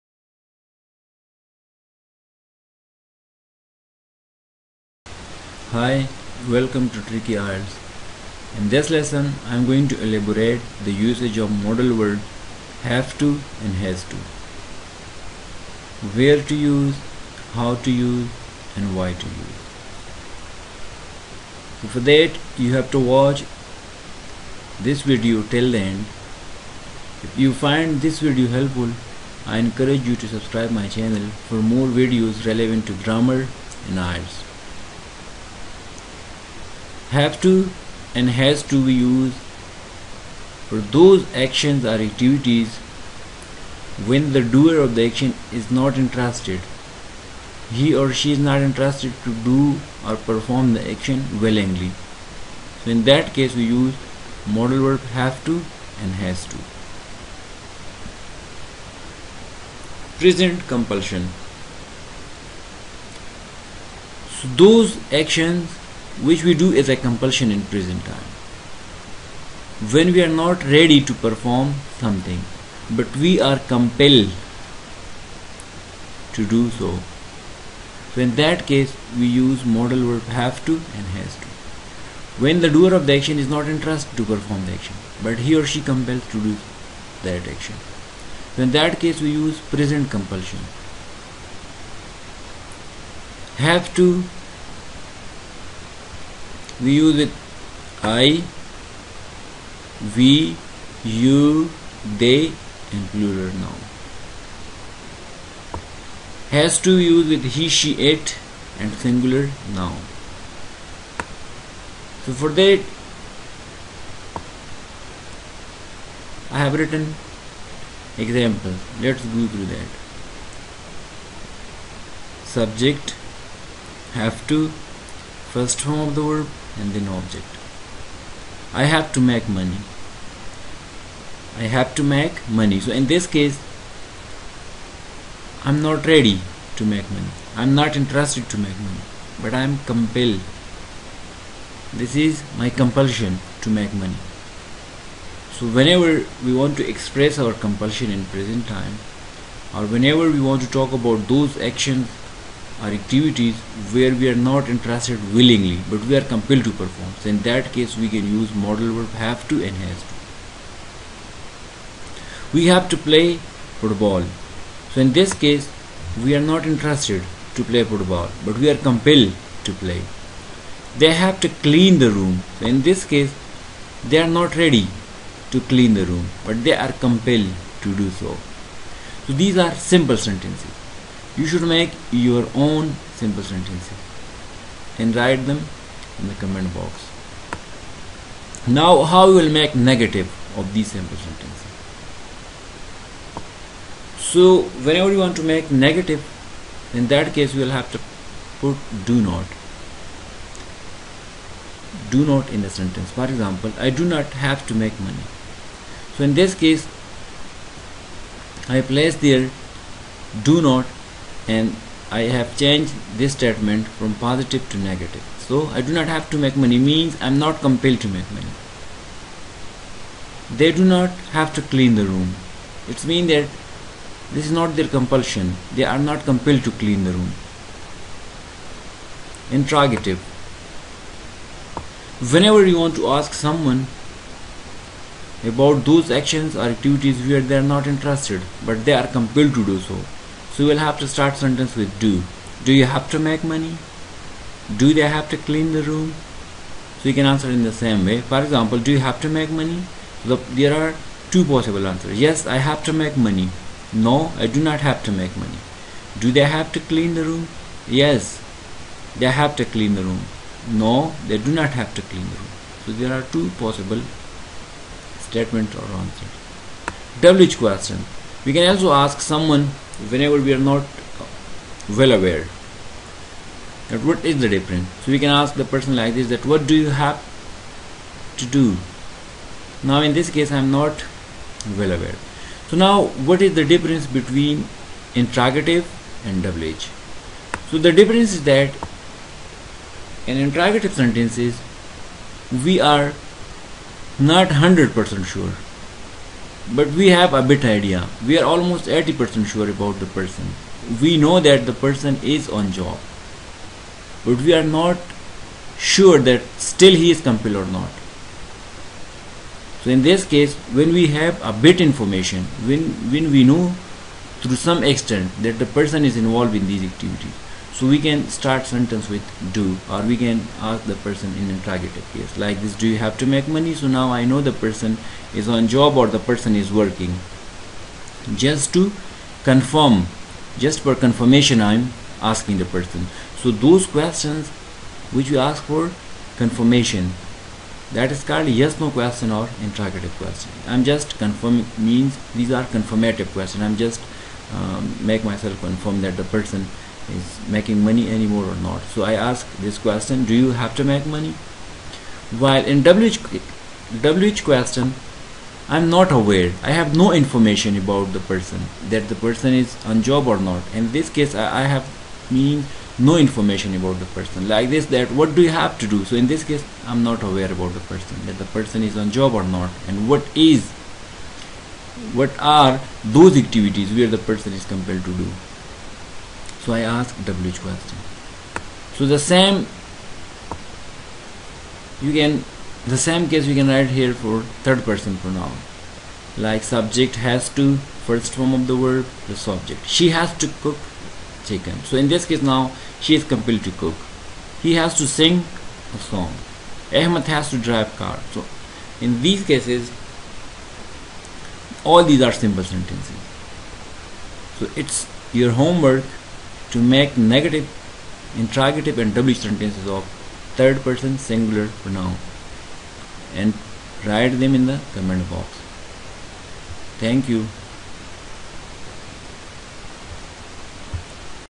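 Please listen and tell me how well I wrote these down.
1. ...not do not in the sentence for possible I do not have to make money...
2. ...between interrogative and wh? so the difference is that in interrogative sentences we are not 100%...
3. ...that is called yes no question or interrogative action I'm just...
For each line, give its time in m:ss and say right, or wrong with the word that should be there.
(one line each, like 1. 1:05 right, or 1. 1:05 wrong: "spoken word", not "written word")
1. 3:19 wrong: "example", not "possible"
2. 4:44 right
3. 5:37 wrong: "question", not "action".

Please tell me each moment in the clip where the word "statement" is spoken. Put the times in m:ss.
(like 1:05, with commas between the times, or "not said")
3:33, 4:25.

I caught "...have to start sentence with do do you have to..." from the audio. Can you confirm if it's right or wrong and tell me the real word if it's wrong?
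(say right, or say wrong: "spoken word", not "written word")
right.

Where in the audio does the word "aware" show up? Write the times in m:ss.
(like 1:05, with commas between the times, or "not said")
4:32, 4:41, 5:56, 6:07.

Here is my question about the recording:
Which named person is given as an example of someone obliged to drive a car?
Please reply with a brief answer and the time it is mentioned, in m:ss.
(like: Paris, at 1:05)
Ahmed, at 6:37.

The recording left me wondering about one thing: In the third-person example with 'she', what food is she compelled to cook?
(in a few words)
chicken.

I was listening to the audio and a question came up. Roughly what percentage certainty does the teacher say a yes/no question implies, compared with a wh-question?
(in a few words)
80%.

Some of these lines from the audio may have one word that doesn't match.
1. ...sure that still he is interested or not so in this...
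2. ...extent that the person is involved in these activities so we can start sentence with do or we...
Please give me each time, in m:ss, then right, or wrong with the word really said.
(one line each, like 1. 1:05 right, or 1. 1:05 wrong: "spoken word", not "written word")
1. 5:05 wrong: "compelled", not "interested"
2. 5:14 right.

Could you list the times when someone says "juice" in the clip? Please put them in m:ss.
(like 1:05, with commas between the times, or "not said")
not said.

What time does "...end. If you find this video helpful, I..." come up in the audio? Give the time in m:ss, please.
0:25.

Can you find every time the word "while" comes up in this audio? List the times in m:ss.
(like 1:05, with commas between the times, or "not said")
5:52.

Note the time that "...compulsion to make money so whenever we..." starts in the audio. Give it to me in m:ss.
2:22.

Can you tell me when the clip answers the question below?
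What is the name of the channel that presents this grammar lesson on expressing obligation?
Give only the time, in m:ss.
0:07.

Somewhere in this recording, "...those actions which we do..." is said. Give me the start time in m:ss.
1:04.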